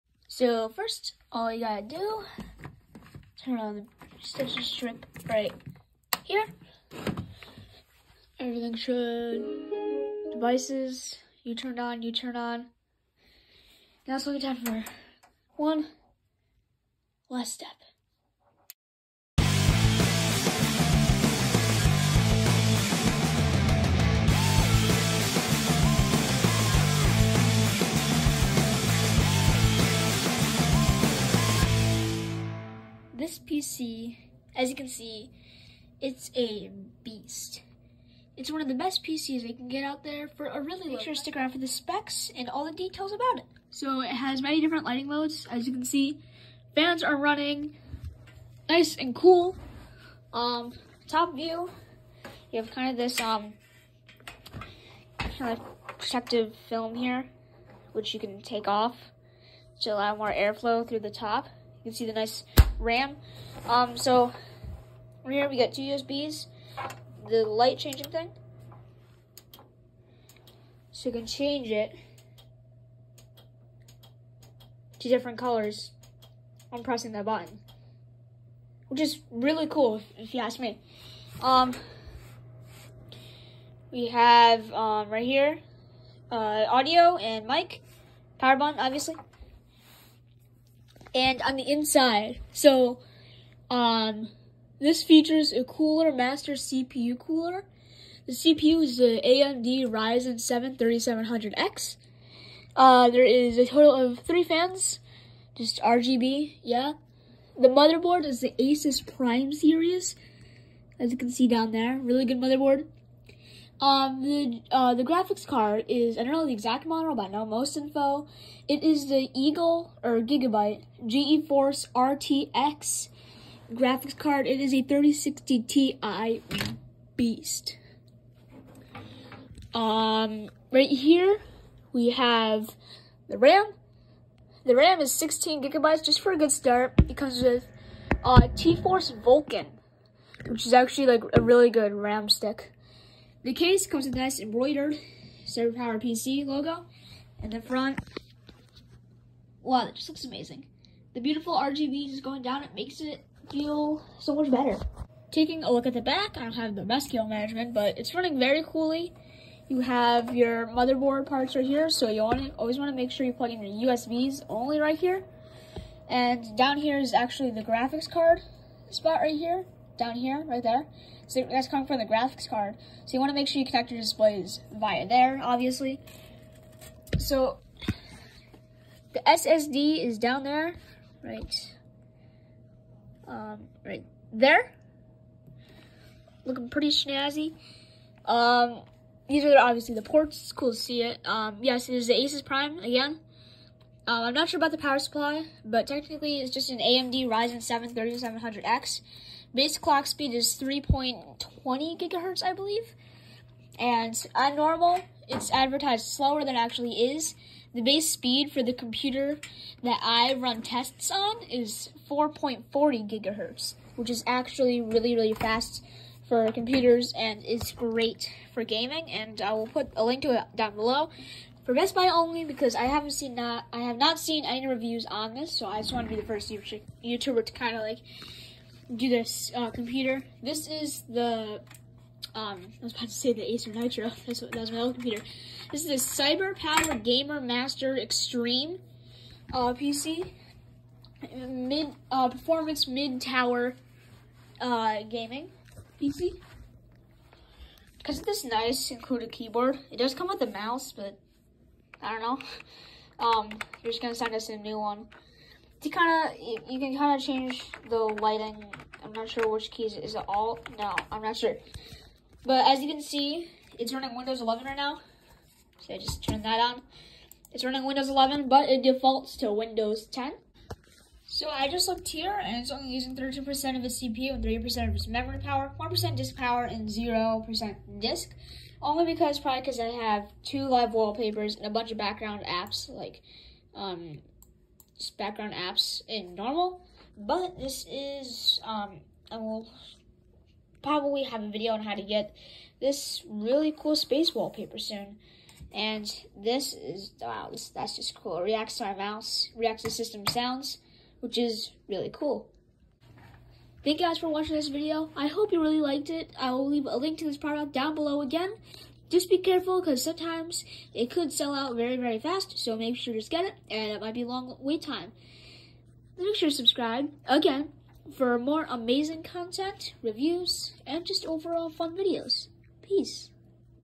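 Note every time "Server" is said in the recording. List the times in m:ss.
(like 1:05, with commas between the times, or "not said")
2:25.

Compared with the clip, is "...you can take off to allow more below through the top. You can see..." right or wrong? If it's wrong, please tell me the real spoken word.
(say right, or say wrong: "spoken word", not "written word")
wrong: "airflow", not "below".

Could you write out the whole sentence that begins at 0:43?
So it has many different lighting modes, as you can see.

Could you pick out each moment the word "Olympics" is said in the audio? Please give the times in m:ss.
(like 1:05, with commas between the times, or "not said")
not said.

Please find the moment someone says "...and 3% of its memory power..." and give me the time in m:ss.
4:34.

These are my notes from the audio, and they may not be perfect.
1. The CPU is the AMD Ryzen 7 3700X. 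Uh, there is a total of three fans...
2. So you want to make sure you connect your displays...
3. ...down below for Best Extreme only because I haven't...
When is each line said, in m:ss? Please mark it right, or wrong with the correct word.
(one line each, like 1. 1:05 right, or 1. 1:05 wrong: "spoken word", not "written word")
1. 1:38 right
2. 2:53 right
3. 3:40 wrong: "Buy", not "Extreme".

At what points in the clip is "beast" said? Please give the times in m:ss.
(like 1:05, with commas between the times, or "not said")
0:37, 2:07.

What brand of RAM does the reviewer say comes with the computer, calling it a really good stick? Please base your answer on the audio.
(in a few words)
T-Force Vulcan.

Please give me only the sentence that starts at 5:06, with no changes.
I will leave a link to this product down below again.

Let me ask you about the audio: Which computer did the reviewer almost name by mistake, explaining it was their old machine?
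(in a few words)
Acer Nitro.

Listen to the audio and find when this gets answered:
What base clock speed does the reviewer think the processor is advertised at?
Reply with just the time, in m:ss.
3:20.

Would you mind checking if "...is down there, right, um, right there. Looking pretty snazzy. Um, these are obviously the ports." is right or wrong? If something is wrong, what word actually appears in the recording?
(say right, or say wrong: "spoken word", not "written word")
right.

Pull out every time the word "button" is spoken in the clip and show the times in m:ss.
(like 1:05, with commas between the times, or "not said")
1:17, 1:28.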